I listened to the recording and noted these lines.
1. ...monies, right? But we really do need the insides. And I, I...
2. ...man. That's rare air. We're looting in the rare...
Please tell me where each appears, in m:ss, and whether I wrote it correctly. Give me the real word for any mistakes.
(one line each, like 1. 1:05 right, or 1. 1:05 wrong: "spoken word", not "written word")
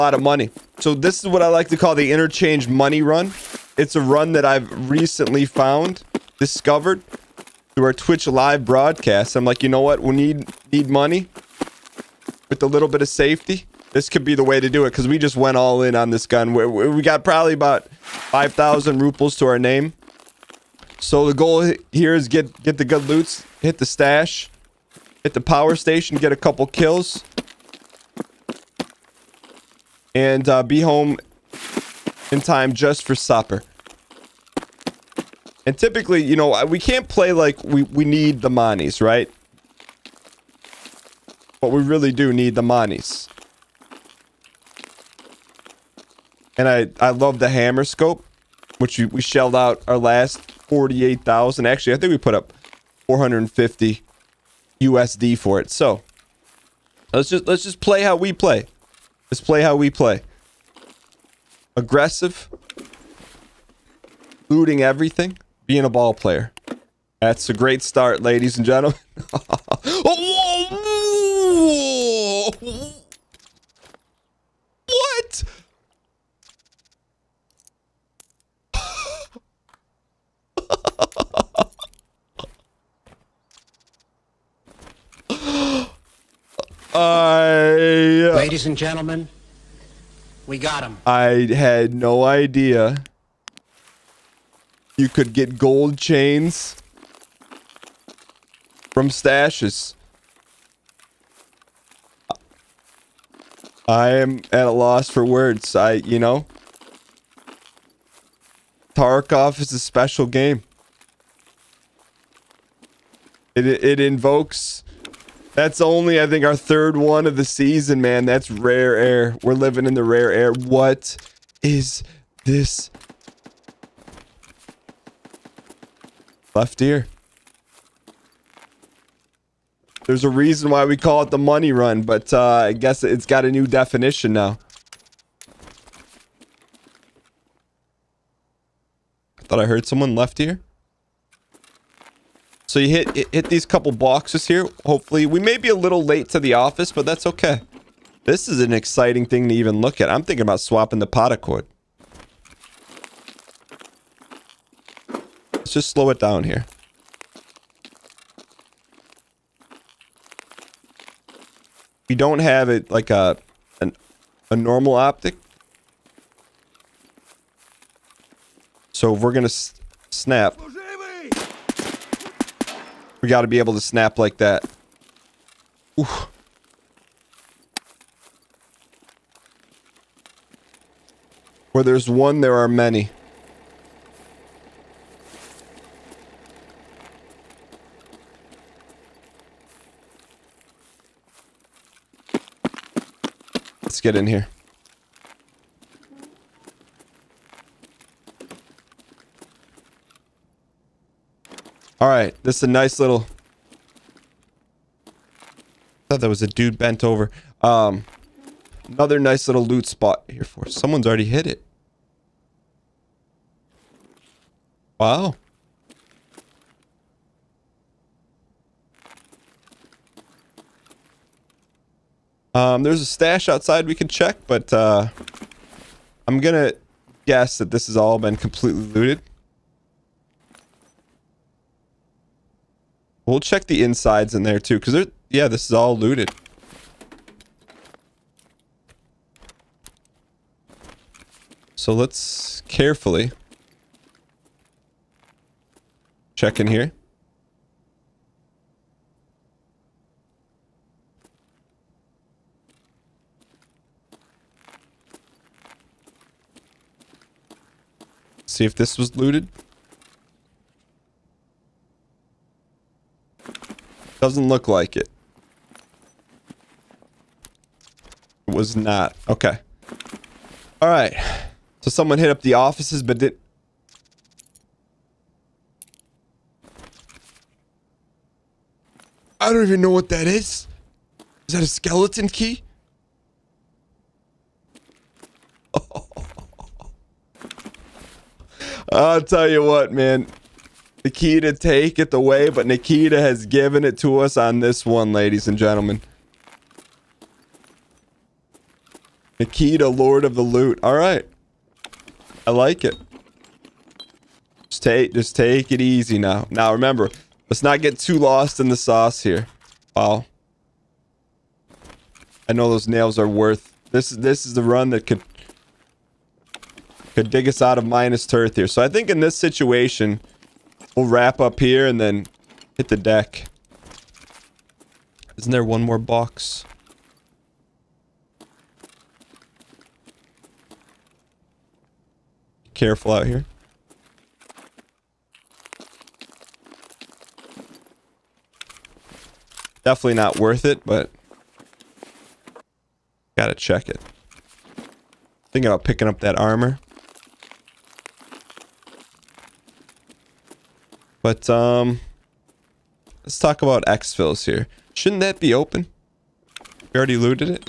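1. 0:38 wrong: "monies", not "insides"
2. 1:58 wrong: "living", not "looting".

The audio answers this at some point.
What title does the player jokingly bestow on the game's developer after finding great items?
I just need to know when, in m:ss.
4:59.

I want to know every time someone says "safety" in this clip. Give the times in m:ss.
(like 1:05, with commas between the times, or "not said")
0:13.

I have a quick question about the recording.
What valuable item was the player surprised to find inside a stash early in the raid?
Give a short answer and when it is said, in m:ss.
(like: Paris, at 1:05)
gold chains, at 1:35.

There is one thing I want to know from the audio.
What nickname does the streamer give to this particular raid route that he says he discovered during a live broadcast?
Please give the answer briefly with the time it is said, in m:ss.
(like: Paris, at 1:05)
interchange money run, at 0:02.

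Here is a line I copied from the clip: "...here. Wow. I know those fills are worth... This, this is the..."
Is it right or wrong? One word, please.
wrong.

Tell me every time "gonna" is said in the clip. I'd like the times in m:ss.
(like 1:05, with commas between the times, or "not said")
2:49, 3:46.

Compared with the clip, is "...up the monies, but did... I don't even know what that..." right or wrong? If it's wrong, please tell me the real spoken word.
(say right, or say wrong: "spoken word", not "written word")
wrong: "offices", not "monies".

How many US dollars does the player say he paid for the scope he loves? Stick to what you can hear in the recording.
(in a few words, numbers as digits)
450.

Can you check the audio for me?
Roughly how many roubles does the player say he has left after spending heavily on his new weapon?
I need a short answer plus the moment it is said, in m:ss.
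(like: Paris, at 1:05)
5,000, at 0:17.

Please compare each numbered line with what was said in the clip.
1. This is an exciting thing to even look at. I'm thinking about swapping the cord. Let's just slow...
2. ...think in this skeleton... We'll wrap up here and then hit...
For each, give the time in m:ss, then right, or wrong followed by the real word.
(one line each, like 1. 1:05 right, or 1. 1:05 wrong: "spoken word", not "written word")
1. 2:28 right
2. 5:18 wrong: "situation", not "skeleton".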